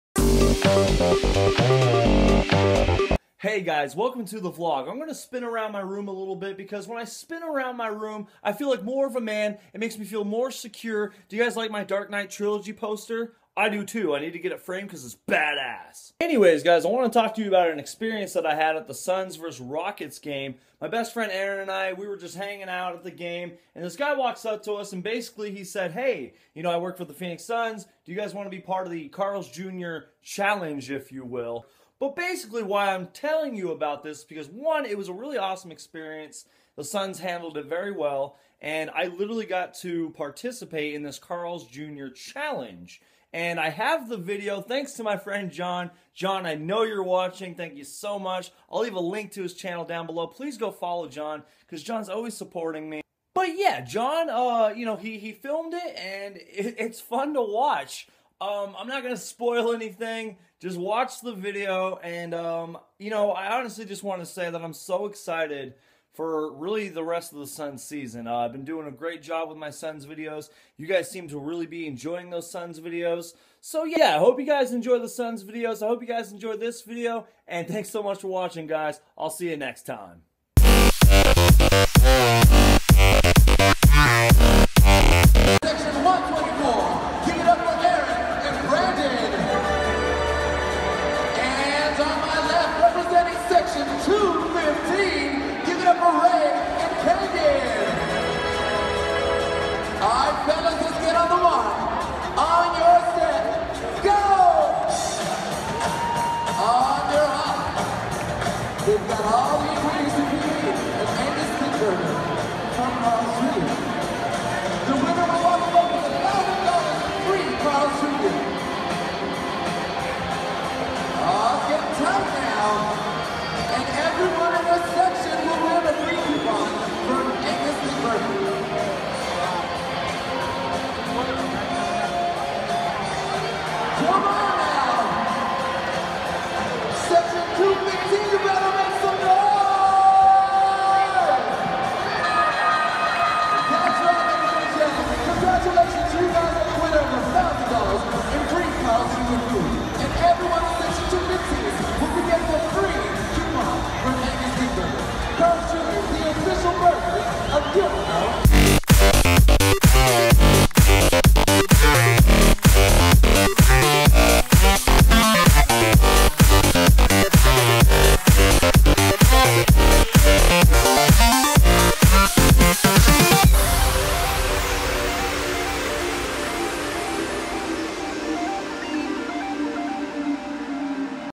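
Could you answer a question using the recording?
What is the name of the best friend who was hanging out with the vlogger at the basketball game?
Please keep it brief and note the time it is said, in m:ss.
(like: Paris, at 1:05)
Aaron, at 0:21.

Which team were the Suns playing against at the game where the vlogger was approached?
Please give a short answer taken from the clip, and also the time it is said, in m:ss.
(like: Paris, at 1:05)
Rockets, at 0:19.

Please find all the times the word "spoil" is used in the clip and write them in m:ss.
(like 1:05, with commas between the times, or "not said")
0:59.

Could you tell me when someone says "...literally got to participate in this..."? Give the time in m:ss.
0:39.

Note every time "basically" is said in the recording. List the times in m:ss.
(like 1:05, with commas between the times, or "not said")
0:25, 0:32.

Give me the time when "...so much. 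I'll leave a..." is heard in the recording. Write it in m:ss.
0:47.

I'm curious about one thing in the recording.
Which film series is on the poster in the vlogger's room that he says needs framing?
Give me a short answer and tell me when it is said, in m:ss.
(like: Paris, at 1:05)
Dark Knight Trilogy, at 0:11.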